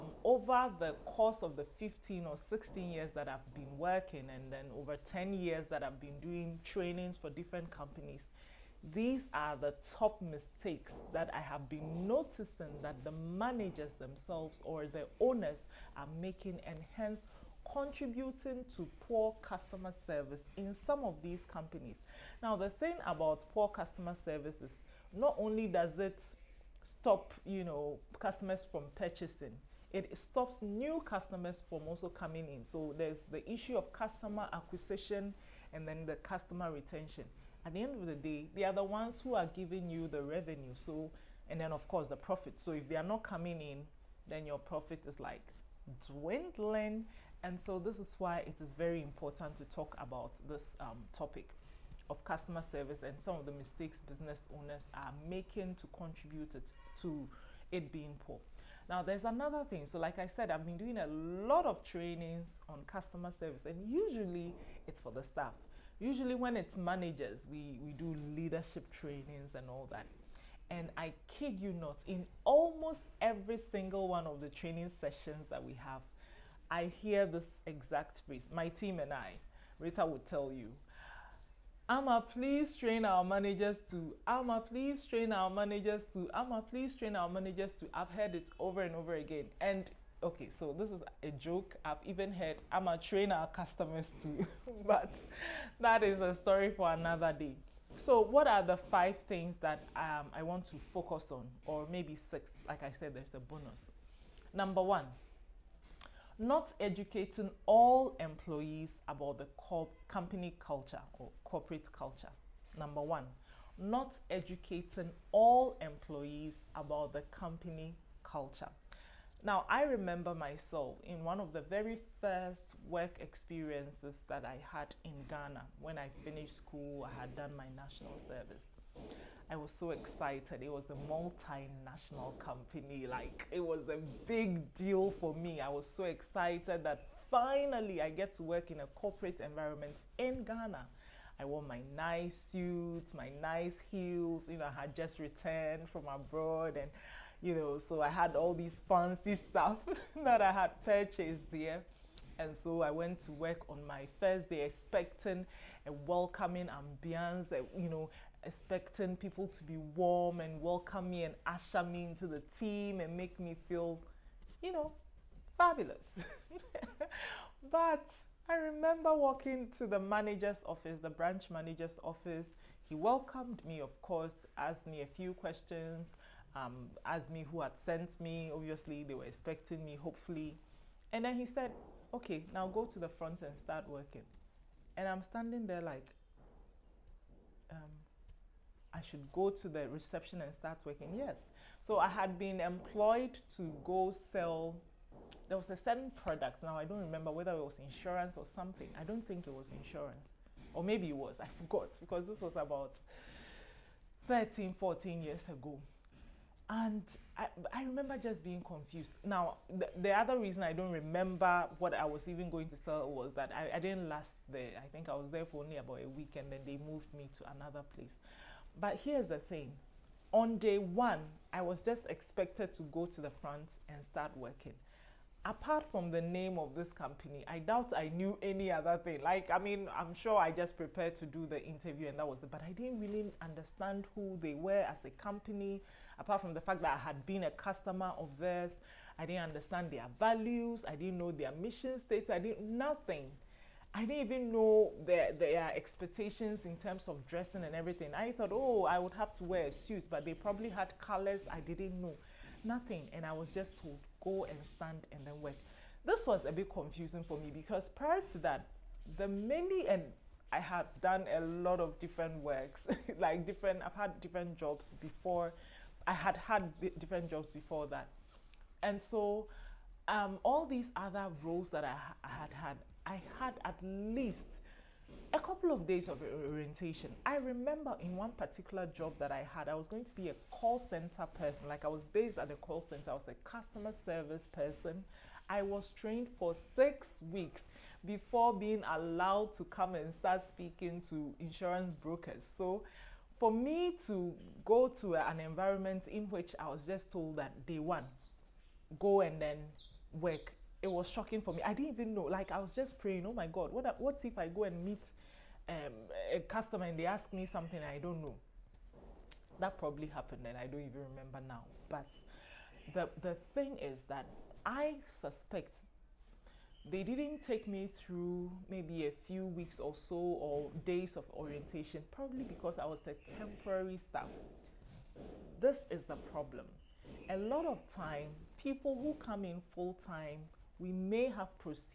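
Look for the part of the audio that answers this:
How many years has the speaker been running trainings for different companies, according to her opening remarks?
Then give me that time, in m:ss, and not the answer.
0:04.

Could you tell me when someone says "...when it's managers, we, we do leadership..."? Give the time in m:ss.
1:06.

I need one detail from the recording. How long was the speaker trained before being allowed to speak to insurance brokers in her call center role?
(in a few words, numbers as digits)
6 weeks.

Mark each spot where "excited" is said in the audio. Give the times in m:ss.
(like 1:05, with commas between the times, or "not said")
2:09, 2:16.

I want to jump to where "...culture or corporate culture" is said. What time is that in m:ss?
1:50.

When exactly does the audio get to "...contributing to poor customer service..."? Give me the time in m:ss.
0:17.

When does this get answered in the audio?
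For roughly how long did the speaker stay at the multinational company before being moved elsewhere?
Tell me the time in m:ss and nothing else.
3:36.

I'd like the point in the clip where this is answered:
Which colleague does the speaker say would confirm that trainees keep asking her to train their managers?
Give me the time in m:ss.
1:19.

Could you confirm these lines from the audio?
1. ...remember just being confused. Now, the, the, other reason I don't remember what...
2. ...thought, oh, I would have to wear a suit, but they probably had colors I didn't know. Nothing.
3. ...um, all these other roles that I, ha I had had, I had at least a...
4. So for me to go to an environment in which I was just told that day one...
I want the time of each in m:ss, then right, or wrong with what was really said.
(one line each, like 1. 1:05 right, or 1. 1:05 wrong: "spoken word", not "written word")
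1. 3:27 right
2. 4:08 right
3. 4:30 right
4. 4:52 right.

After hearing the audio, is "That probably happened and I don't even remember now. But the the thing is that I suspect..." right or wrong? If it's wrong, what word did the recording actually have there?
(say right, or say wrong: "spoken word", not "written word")
right.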